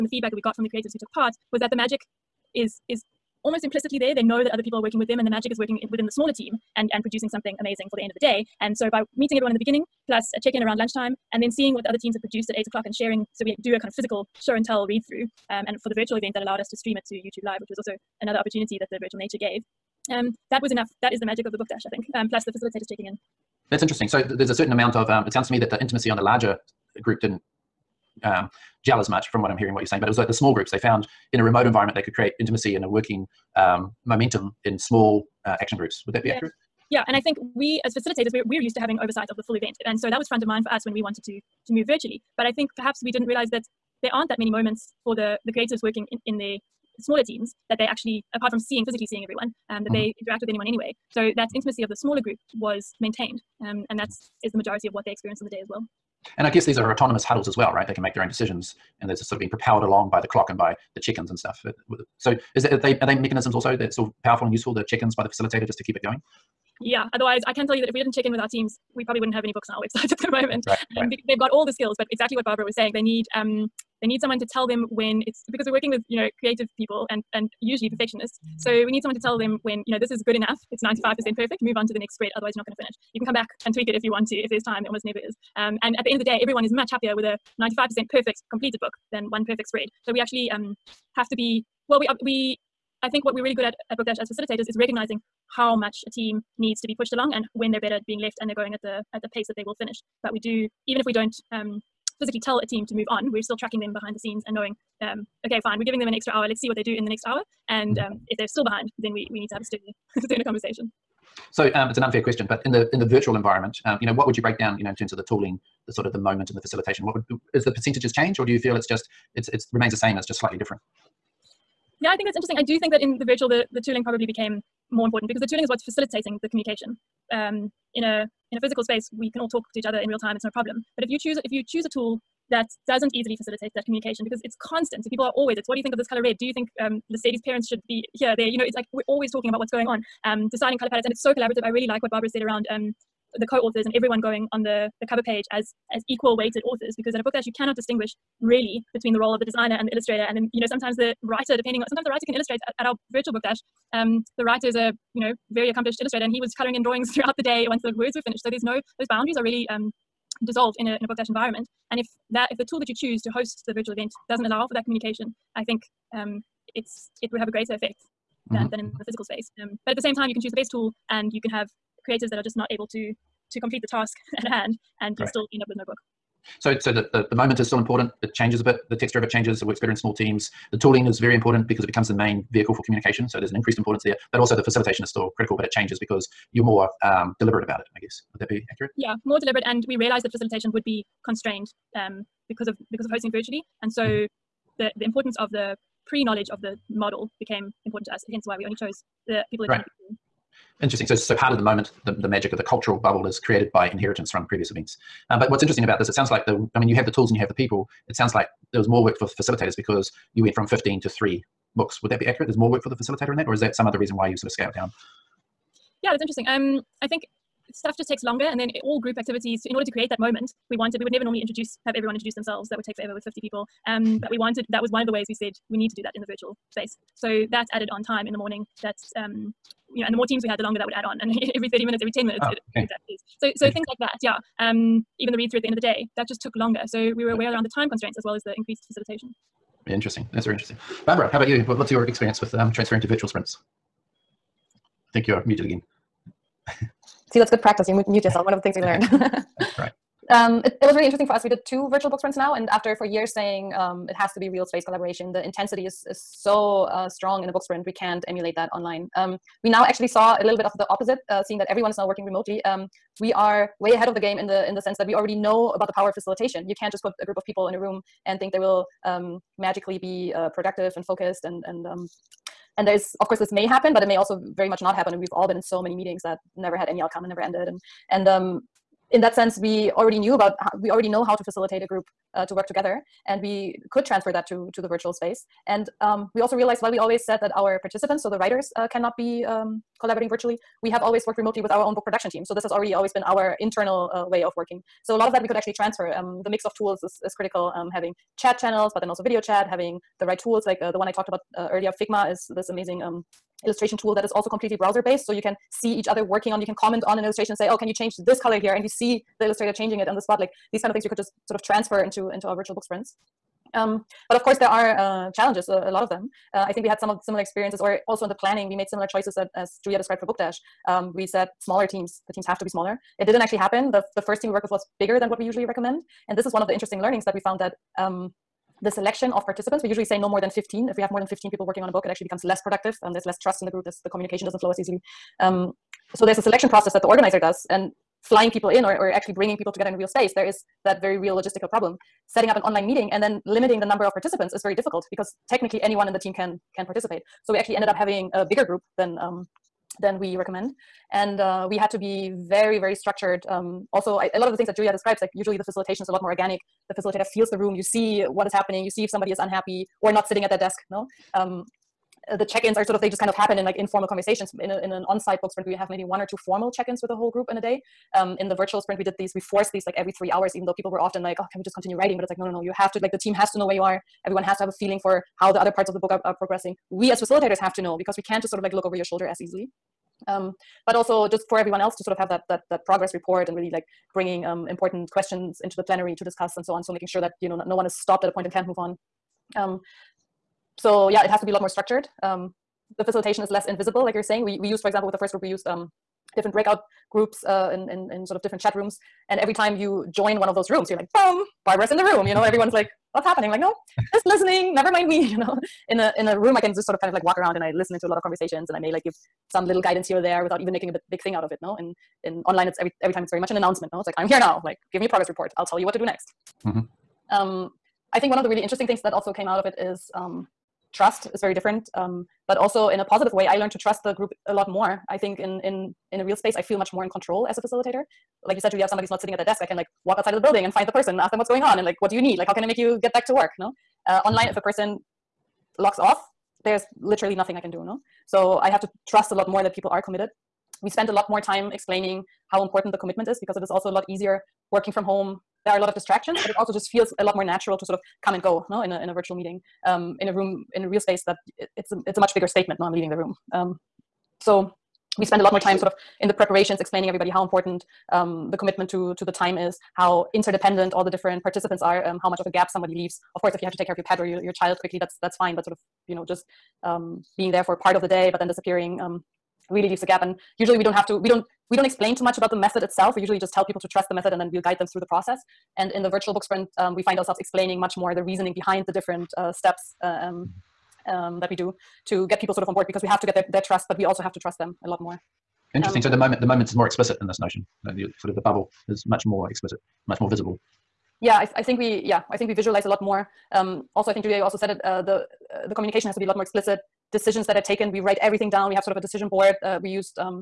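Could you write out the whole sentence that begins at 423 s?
I learned to trust the group a lot more.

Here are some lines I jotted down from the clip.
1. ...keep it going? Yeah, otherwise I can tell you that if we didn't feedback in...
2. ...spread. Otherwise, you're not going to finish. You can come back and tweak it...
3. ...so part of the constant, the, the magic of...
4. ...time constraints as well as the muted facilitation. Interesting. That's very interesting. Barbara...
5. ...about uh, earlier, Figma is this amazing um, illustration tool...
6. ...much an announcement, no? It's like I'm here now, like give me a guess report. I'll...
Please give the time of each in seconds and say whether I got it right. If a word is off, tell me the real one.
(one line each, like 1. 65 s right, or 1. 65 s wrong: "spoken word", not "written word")
1. 65 s wrong: "check", not "feedback"
2. 82 s right
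3. 201 s wrong: "moment", not "constant"
4. 237 s wrong: "increased", not "muted"
5. 301 s right
6. 413 s wrong: "progress", not "guess".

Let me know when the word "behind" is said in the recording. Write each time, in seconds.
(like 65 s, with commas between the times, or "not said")
103 s, 108 s, 478 s.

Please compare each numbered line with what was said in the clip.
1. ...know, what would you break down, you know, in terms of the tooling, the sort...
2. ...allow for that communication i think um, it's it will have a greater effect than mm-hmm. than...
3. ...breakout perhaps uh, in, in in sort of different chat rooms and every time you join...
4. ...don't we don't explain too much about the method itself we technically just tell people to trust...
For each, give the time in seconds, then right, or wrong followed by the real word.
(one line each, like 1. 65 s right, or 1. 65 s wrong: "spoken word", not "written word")
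1. 114 s right
2. 164 s right
3. 396 s wrong: "groups", not "perhaps"
4. 471 s wrong: "usually", not "technically".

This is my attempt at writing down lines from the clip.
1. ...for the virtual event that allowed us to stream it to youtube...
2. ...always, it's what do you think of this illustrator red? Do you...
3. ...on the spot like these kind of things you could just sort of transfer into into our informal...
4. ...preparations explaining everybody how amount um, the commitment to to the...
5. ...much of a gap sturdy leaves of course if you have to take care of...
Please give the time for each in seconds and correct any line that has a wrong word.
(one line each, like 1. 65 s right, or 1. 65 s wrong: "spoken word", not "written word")
1. 15 s right
2. 135 s wrong: "color", not "illustrator"
3. 310 s wrong: "virtual", not "informal"
4. 456 s wrong: "important", not "amount"
5. 462 s wrong: "somebody", not "sturdy".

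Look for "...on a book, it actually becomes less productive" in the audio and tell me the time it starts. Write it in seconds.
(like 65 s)
331 s.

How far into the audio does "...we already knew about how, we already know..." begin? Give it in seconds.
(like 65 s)
279 s.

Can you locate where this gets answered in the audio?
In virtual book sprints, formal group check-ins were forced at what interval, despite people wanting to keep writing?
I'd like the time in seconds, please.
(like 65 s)
369 s.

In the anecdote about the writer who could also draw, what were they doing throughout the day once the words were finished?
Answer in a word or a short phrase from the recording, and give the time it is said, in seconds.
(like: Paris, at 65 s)
coloring in drawings, at 156 s.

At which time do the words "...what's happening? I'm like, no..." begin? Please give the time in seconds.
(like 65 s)
403 s.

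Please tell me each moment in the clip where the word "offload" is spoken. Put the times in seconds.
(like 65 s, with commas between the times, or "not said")
not said.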